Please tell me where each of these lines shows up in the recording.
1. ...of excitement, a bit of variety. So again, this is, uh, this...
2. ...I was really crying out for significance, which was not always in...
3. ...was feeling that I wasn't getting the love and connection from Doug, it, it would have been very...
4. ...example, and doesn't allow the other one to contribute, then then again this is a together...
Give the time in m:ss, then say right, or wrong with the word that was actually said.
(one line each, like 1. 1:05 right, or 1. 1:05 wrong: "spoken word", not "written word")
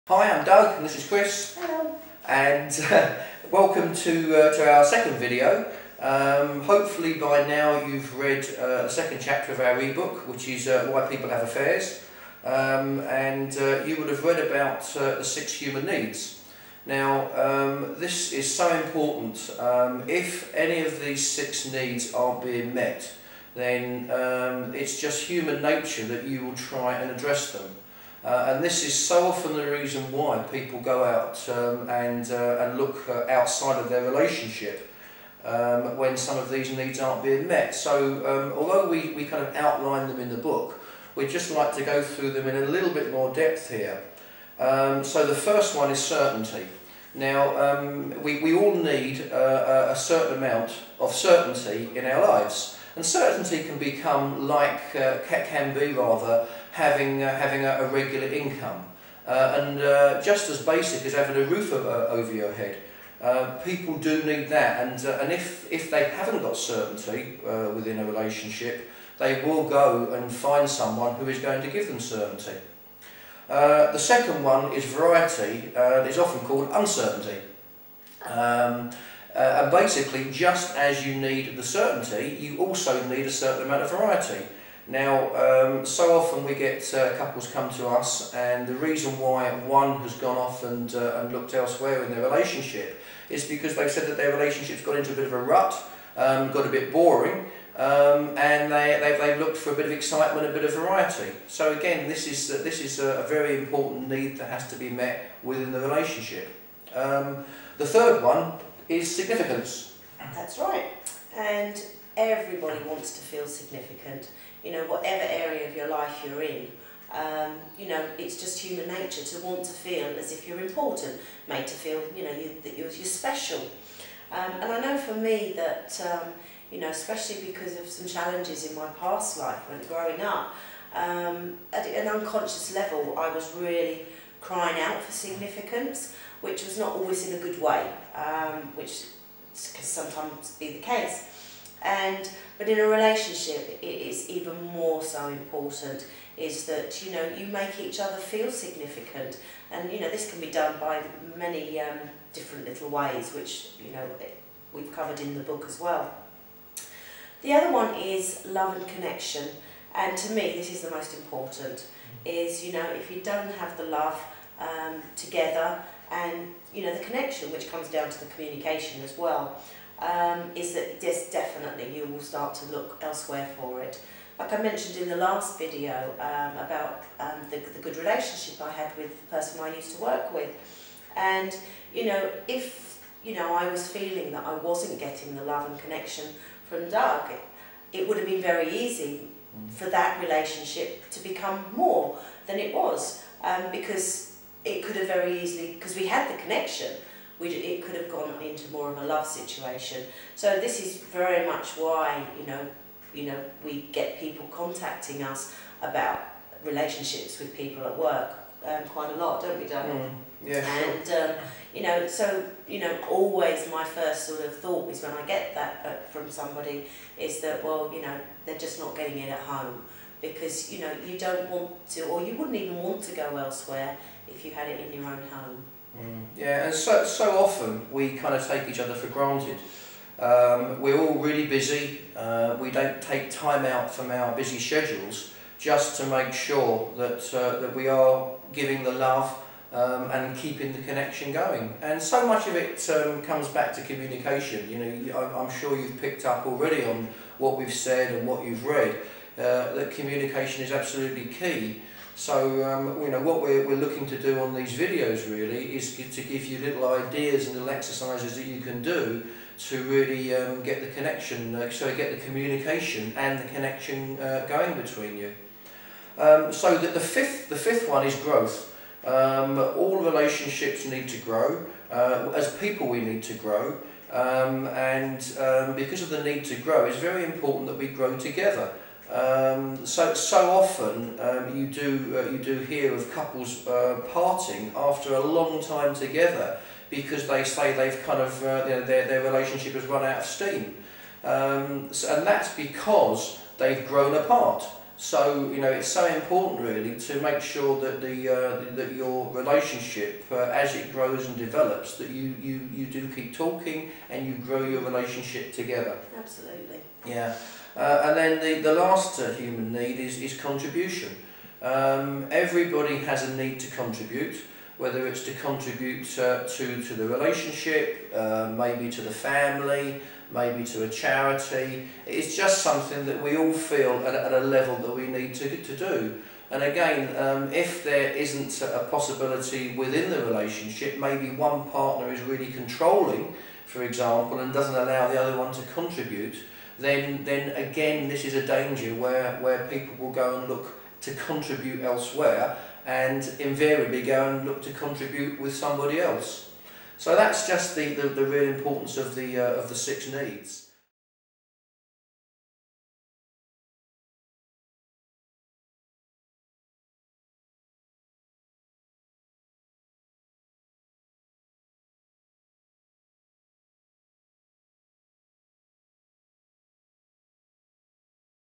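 1. 1:39 right
2. 2:13 right
3. 3:03 right
4. 5:33 wrong: "danger", not "together".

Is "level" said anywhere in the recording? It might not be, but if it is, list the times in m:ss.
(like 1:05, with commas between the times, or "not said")
2:12, 5:24.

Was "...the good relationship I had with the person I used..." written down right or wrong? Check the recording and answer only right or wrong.
right.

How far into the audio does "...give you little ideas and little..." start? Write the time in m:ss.
4:16.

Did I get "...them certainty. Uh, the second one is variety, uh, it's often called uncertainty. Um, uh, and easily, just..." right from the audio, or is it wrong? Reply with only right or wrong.
wrong.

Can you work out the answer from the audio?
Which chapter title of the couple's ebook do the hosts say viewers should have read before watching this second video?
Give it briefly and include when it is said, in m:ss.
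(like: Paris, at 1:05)
Why People Have Affairs, at 0:10.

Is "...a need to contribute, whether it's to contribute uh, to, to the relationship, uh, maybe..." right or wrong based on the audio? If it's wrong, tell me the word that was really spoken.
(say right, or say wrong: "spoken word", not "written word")
right.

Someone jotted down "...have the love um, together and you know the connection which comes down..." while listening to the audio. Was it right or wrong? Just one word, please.
right.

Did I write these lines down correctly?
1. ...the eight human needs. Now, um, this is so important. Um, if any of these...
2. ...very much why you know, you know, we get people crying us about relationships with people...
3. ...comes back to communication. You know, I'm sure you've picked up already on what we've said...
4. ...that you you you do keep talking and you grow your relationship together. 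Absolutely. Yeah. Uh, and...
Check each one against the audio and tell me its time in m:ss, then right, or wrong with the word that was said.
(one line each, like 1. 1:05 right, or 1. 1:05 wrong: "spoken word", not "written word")
1. 0:15 wrong: "six", not "eight"
2. 3:21 wrong: "contacting", not "crying"
3. 4:03 right
4. 5:01 right.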